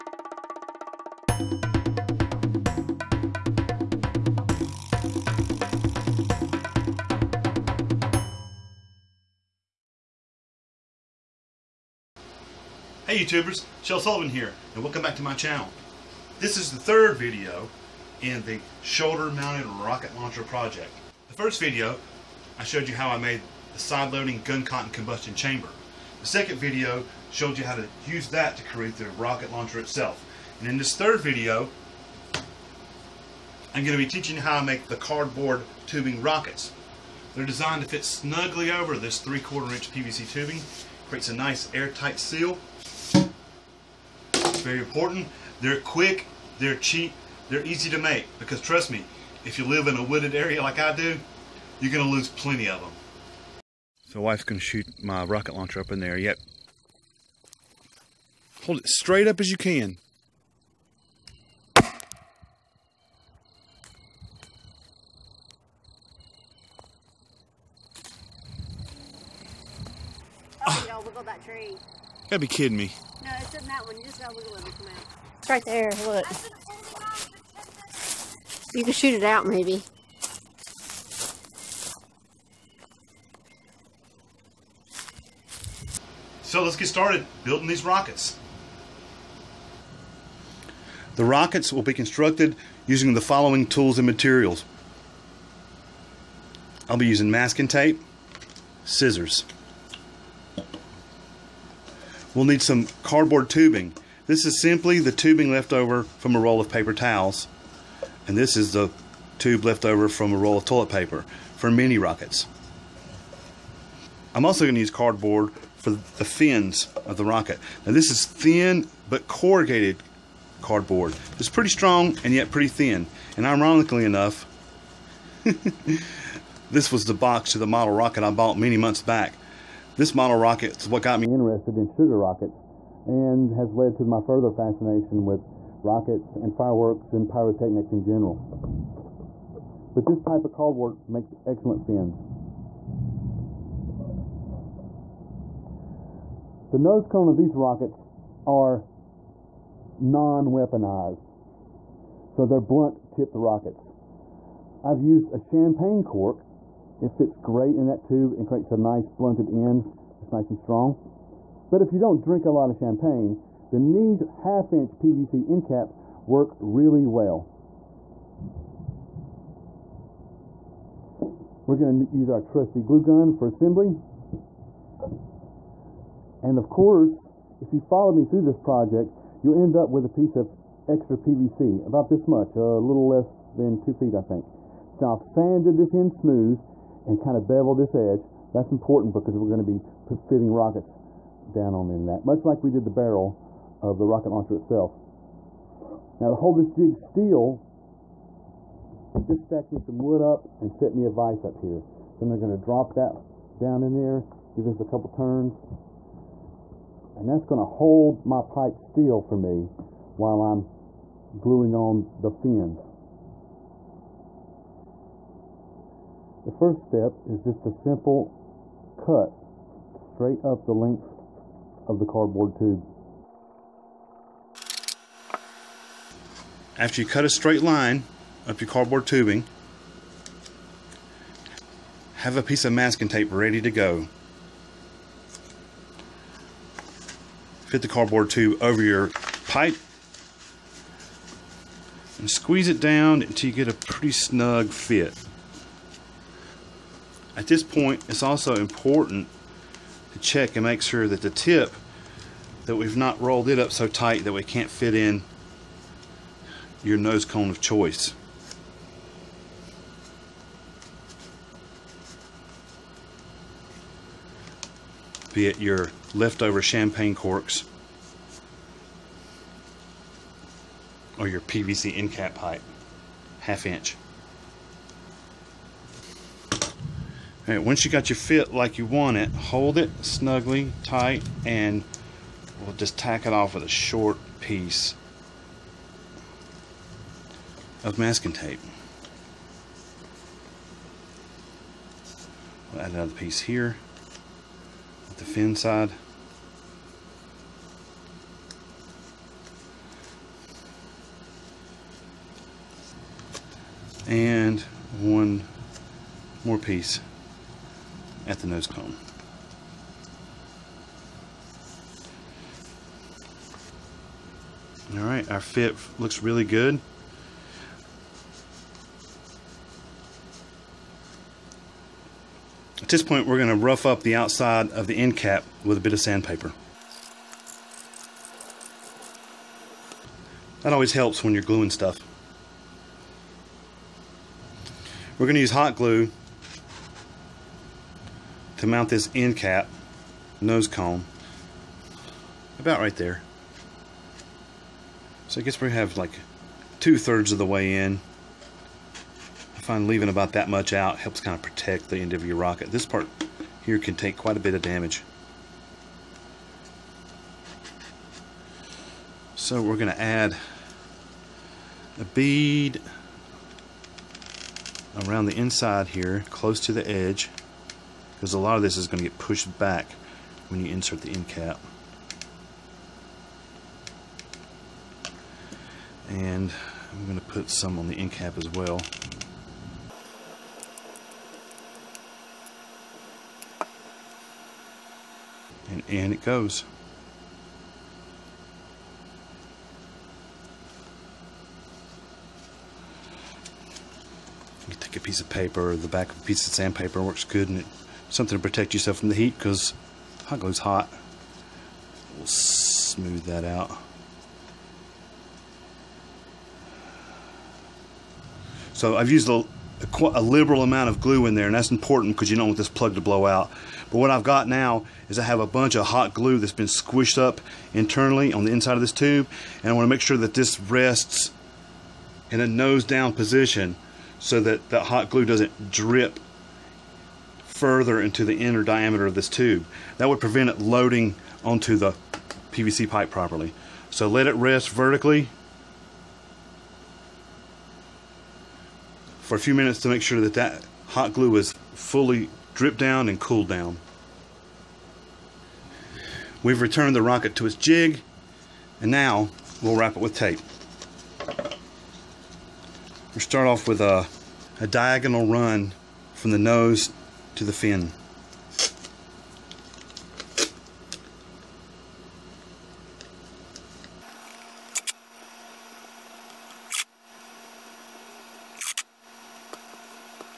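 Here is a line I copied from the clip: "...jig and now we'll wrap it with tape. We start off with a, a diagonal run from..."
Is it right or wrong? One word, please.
right.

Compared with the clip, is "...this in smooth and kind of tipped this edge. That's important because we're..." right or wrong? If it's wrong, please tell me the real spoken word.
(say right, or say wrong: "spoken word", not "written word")
wrong: "beveled", not "tipped".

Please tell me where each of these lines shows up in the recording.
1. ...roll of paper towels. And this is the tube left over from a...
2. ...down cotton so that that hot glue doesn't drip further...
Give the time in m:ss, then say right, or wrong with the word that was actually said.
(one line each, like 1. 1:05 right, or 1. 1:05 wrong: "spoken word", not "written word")
1. 1:46 right
2. 7:02 wrong: "position", not "cotton".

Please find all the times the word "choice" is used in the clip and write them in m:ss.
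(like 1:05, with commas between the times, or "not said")
4:17.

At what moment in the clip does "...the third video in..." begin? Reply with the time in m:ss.
0:16.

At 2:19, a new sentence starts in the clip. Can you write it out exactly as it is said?
But this type of cardboard makes excellent fins.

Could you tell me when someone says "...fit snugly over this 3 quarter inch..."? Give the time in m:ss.
0:37.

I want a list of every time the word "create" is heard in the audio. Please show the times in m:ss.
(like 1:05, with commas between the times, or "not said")
0:28, 0:41, 2:38.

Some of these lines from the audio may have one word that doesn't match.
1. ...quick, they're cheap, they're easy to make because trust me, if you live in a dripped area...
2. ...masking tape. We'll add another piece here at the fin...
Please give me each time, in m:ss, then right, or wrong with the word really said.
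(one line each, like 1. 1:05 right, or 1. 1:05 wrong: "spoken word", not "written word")
1. 0:45 wrong: "wooded", not "dripped"
2. 4:47 right.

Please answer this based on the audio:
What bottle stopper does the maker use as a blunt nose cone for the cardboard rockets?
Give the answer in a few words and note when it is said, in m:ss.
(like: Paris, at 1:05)
Champagne cork, at 2:35.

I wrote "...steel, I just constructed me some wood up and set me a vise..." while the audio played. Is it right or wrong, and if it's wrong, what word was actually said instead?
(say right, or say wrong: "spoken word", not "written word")
wrong: "stacked", not "constructed".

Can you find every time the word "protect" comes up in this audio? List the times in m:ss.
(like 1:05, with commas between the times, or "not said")
5:51, 6:38.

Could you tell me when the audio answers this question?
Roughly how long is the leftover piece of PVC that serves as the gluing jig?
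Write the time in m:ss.
3:02.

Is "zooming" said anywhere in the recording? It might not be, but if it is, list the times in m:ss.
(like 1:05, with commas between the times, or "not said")
not said.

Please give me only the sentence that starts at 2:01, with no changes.
It's pretty strong and yet pretty thin.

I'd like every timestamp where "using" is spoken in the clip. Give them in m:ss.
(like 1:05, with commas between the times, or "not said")
1:32, 1:37.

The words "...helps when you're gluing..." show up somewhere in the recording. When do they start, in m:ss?
5:30.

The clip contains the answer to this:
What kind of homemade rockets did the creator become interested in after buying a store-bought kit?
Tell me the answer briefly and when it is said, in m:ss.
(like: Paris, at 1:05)
Sugar rockets, at 2:11.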